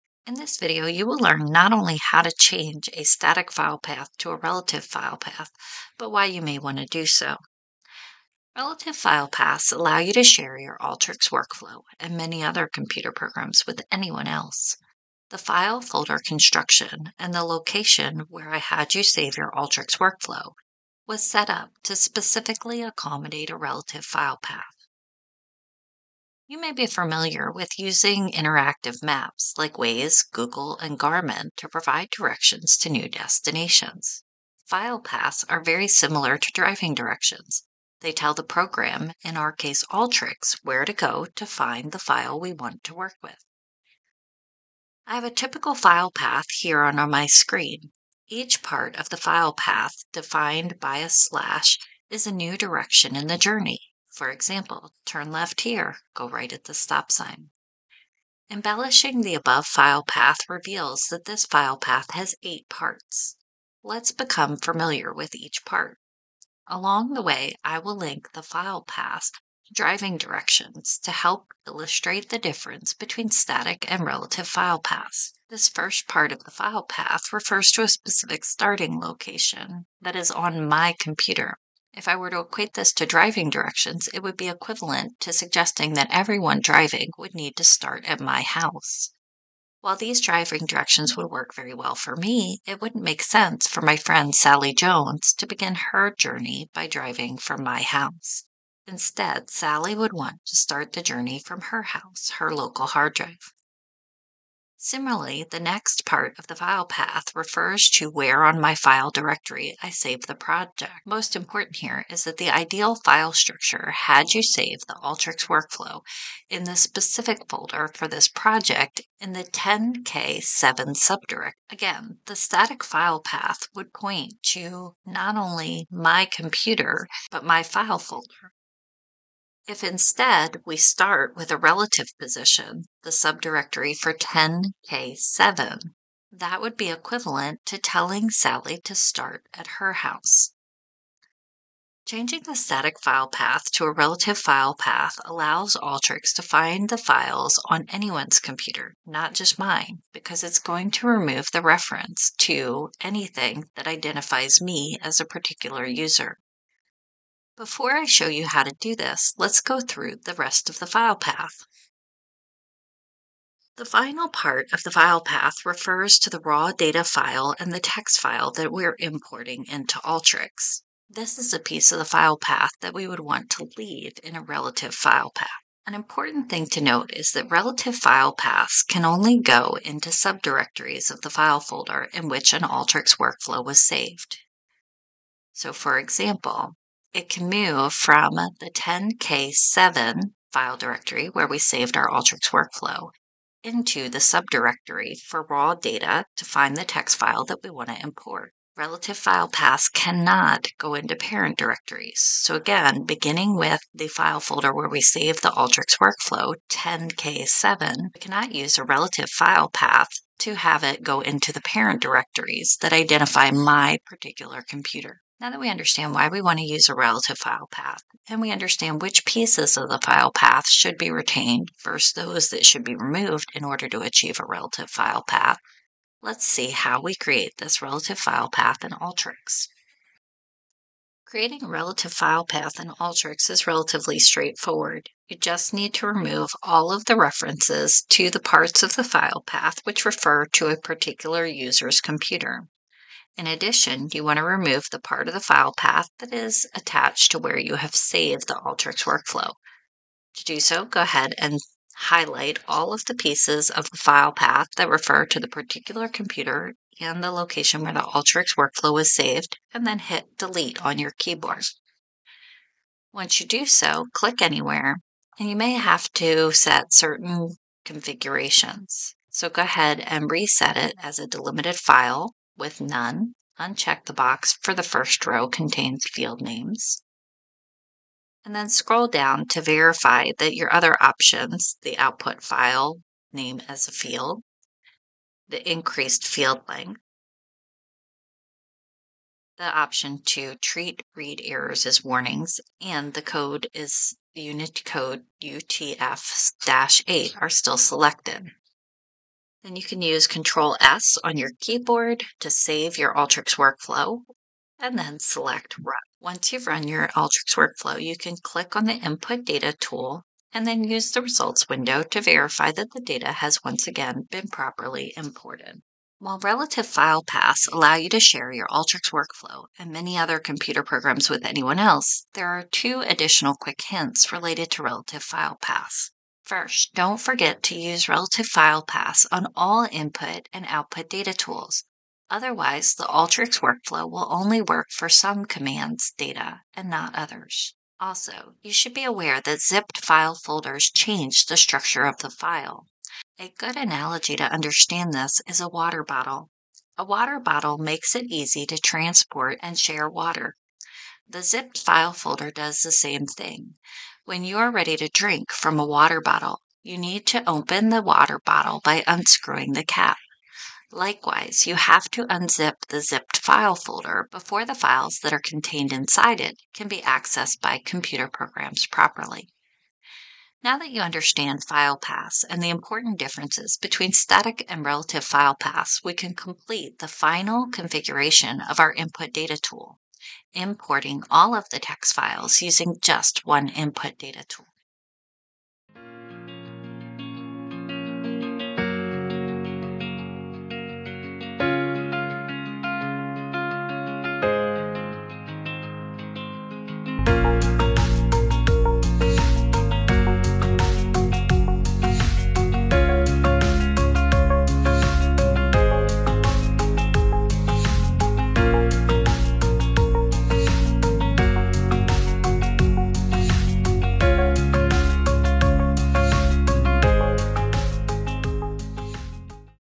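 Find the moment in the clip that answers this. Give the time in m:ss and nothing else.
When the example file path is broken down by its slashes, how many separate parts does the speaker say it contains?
1:02.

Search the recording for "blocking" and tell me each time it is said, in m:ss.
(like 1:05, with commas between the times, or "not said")
not said.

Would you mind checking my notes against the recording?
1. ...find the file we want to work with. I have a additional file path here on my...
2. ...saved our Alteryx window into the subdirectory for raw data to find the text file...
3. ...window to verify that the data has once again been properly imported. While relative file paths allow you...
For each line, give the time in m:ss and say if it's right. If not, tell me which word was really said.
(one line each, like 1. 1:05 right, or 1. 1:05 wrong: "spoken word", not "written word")
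1. 0:41 wrong: "typical", not "additional"
2. 3:11 wrong: "workflow", not "window"
3. 5:11 right.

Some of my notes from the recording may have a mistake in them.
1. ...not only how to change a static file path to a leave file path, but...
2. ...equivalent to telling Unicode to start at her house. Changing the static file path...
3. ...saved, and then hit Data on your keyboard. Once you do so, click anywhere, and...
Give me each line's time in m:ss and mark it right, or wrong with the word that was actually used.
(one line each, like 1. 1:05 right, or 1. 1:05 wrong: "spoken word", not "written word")
1. 0:01 wrong: "relative", not "leave"
2. 2:16 wrong: "Sally", not "Unicode"
3. 4:19 wrong: "Delete", not "Data".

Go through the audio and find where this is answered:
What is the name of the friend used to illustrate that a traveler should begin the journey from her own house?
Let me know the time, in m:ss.
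1:34.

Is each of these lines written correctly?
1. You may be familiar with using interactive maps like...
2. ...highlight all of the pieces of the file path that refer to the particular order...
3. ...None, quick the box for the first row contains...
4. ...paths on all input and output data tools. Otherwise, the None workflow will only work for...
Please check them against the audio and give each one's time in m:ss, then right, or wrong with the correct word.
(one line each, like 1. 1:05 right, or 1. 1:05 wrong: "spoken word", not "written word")
1. 0:26 right
2. 4:11 wrong: "computer", not "order"
3. 4:32 wrong: "uncheck", not "quick"
4. 5:28 wrong: "Alteryx", not "None".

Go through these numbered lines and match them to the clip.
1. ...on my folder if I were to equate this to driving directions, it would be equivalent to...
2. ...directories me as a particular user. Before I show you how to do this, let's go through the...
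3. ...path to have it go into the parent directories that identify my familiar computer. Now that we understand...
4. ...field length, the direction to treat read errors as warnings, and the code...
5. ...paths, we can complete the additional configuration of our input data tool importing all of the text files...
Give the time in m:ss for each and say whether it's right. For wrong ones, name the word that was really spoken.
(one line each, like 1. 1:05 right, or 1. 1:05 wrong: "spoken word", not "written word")
1. 1:20 wrong: "computer", not "folder"
2. 2:33 wrong: "identifies", not "directories"
3. 3:29 wrong: "particular", not "familiar"
4. 4:46 wrong: "option", not "direction"
5. 6:15 wrong: "final", not "additional".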